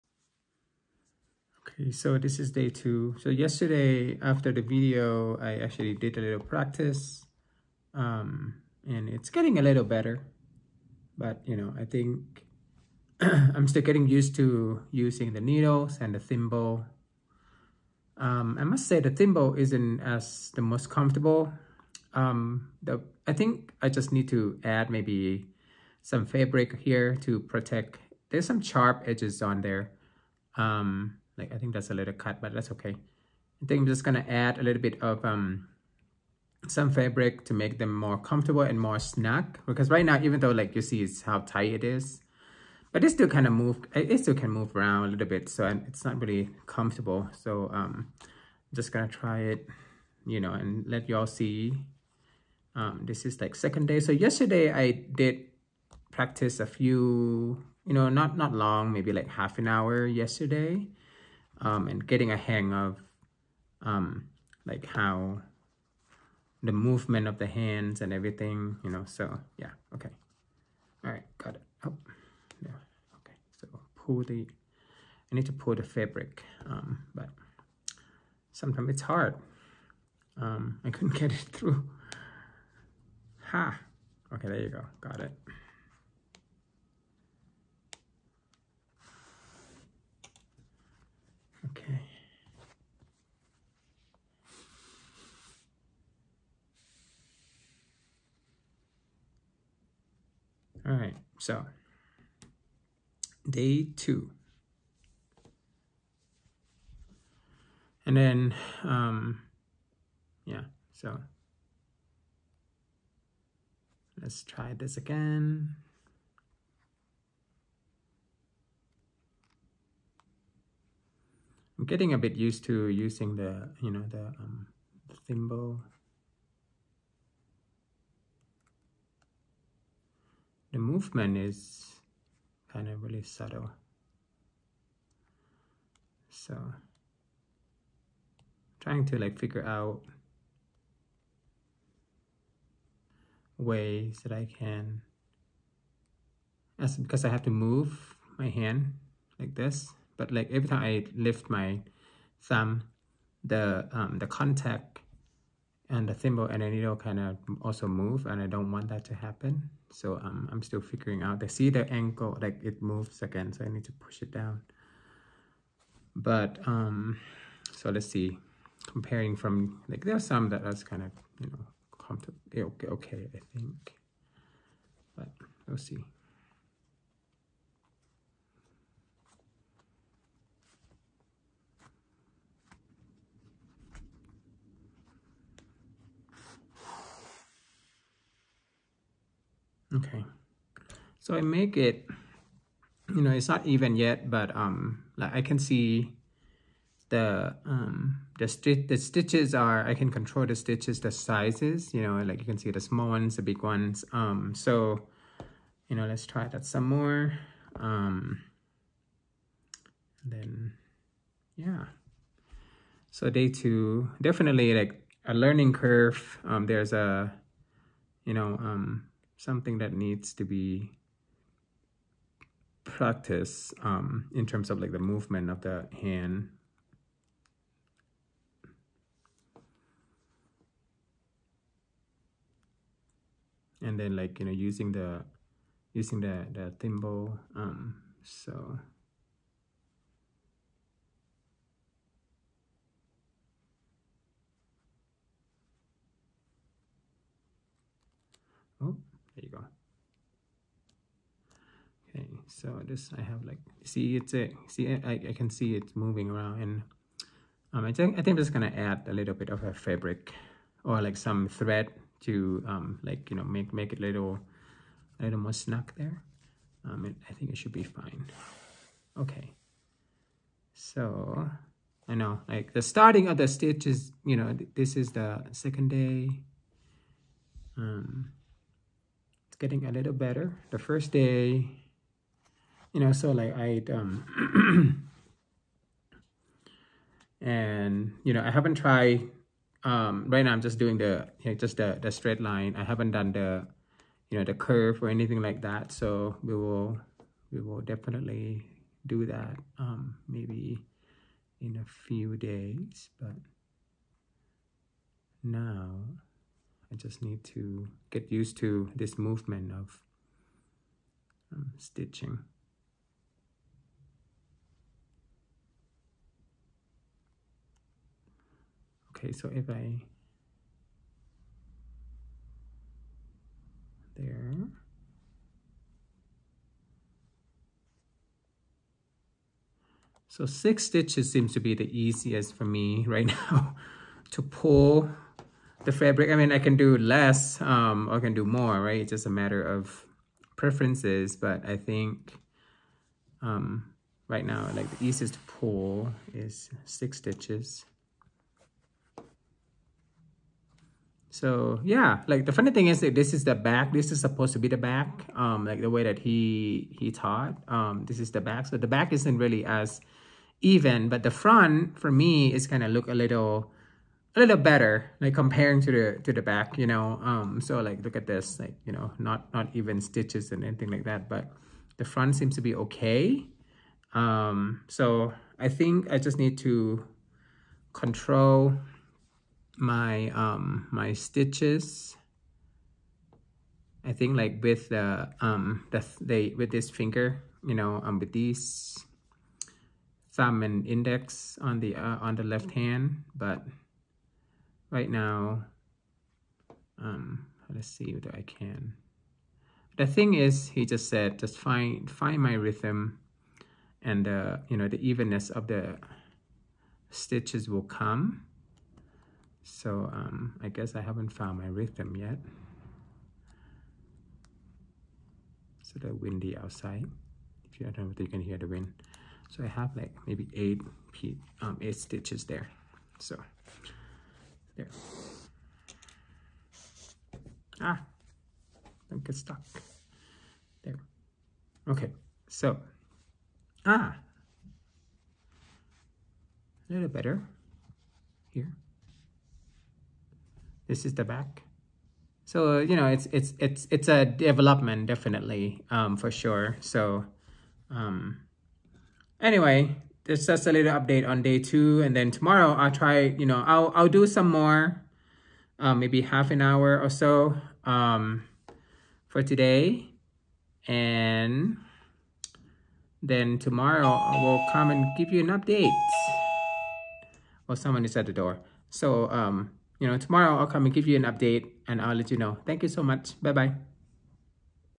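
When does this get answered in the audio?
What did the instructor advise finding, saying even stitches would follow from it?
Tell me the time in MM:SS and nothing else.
06:42.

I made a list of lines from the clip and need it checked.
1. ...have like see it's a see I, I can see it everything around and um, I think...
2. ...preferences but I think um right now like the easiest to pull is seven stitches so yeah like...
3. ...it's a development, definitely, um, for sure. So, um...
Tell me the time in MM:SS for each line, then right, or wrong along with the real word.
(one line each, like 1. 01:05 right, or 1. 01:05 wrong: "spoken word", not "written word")
1. 04:13 wrong: "moving", not "everything"
2. 05:40 wrong: "six", not "seven"
3. 07:23 right.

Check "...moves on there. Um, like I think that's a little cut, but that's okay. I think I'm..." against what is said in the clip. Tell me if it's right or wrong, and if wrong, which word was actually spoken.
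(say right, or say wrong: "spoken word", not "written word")
wrong: "edges", not "moves".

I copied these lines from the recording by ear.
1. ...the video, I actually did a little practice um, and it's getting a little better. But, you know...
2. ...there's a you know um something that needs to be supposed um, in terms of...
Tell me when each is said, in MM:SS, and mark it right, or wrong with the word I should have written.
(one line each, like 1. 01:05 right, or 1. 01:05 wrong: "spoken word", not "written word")
1. 00:04 right
2. 03:36 wrong: "practiced", not "supposed".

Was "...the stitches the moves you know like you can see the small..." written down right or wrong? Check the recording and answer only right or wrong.
wrong.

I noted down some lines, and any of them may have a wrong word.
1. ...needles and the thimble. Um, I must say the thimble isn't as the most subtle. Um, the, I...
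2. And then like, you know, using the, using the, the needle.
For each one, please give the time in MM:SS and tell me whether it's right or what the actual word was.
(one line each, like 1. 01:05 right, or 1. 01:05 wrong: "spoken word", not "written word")
1. 00:15 wrong: "comfortable", not "subtle"
2. 03:53 wrong: "thimble", not "needle".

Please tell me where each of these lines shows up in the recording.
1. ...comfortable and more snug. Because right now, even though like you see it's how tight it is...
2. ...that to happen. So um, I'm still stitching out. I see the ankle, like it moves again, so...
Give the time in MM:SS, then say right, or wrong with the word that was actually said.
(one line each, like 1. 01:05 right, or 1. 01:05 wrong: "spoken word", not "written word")
1. 00:38 right
2. 02:38 wrong: "figuring", not "stitching".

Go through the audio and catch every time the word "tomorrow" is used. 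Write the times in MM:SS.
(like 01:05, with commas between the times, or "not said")
07:32, 07:43, 07:50.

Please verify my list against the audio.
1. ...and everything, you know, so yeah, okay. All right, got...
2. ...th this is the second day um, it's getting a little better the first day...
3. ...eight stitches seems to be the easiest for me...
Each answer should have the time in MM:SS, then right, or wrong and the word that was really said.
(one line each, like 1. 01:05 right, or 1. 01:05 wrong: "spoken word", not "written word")
1. 01:08 right
2. 04:34 right
3. 05:30 wrong: "six", not "eight".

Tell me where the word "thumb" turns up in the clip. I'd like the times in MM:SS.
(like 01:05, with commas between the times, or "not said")
02:32, 06:30.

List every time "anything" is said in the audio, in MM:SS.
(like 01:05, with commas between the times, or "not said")
04:55, 06:10.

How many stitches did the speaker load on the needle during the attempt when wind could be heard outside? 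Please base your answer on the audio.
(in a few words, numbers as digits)
8.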